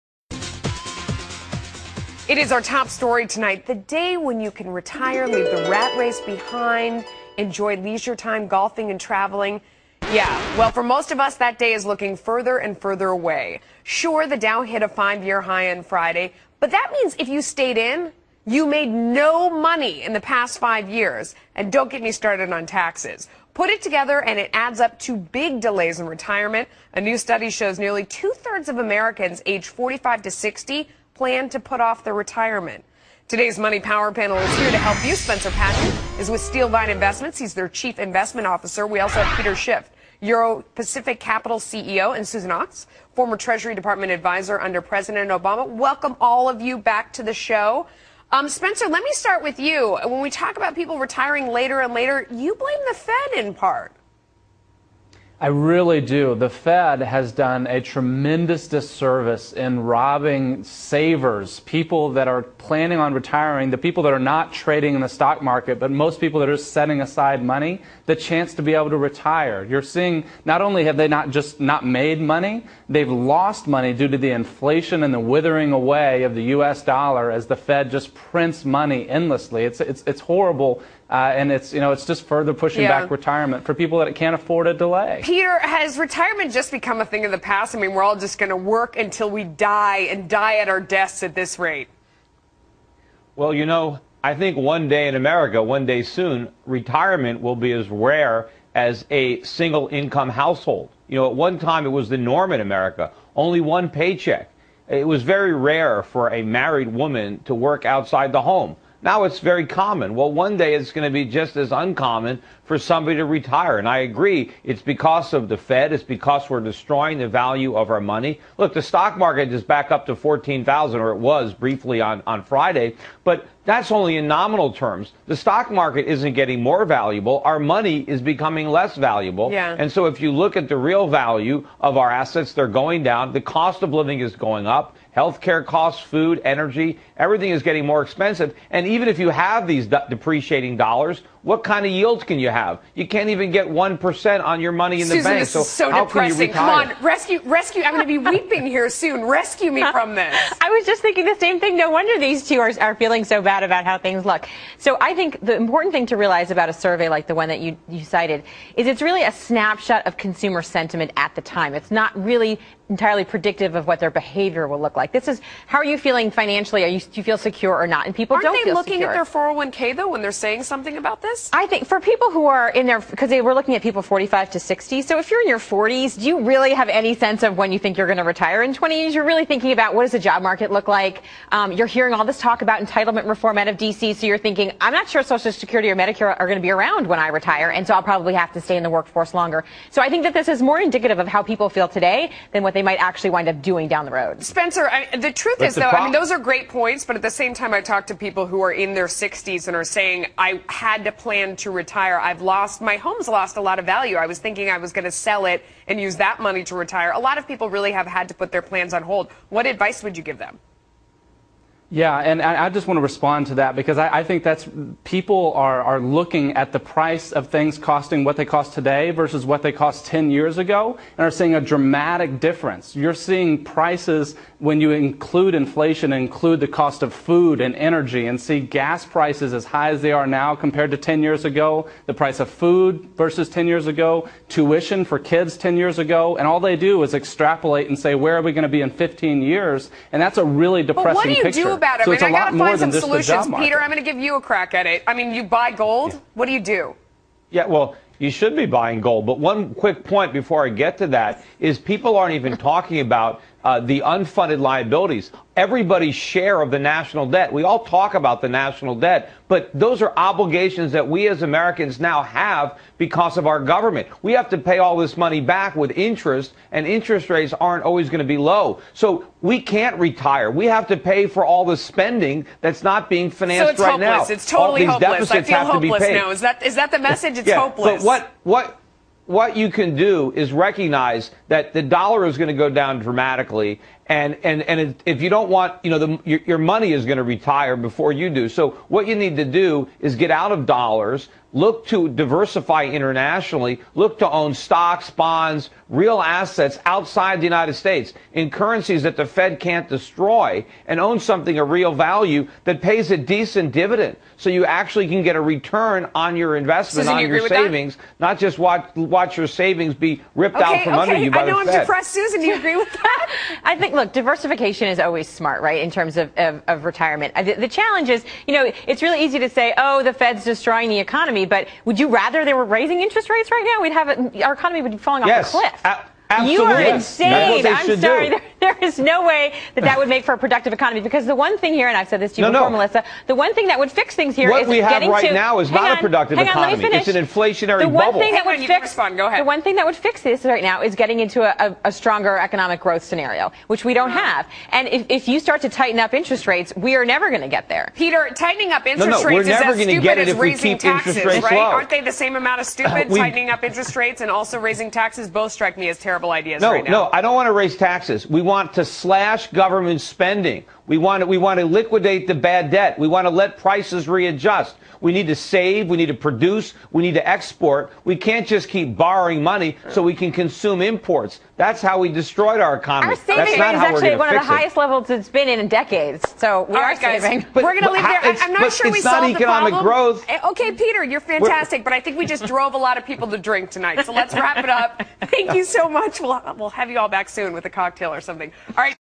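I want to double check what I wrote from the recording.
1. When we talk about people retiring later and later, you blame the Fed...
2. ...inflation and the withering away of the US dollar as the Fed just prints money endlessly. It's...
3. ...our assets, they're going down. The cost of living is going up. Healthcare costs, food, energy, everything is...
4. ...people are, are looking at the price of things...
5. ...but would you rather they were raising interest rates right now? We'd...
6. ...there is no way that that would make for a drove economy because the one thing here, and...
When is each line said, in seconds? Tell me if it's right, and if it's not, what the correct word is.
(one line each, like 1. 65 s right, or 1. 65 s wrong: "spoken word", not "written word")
1. 50 s right
2. 74 s right
3. 131 s right
4. 215 s right
5. 321 s right
6. 328 s wrong: "productive", not "drove".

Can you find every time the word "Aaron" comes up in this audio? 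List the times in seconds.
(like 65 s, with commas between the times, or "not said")
not said.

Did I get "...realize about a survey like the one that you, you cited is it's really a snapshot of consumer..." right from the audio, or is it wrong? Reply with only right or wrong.
right.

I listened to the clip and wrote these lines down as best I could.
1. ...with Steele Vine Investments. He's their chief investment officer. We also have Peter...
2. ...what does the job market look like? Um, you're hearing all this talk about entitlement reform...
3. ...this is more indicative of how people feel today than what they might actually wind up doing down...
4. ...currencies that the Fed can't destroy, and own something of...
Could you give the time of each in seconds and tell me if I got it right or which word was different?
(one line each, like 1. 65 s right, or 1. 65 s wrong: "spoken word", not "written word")
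1. 36 s right
2. 179 s right
3. 190 s right
4. 298 s right.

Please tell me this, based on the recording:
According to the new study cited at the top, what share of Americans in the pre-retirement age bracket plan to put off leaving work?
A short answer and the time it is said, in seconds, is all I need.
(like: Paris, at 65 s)
two thirds, at 27 s.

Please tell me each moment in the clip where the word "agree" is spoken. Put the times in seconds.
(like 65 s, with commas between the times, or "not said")
113 s, 312 s.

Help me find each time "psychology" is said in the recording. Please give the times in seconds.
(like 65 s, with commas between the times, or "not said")
not said.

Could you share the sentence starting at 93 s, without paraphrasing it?
Well, you know, I think one day in America, one day soon, retirement will be as rare as a single income household.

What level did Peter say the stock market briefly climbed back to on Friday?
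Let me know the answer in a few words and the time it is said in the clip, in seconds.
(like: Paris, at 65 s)
14,000, at 120 s.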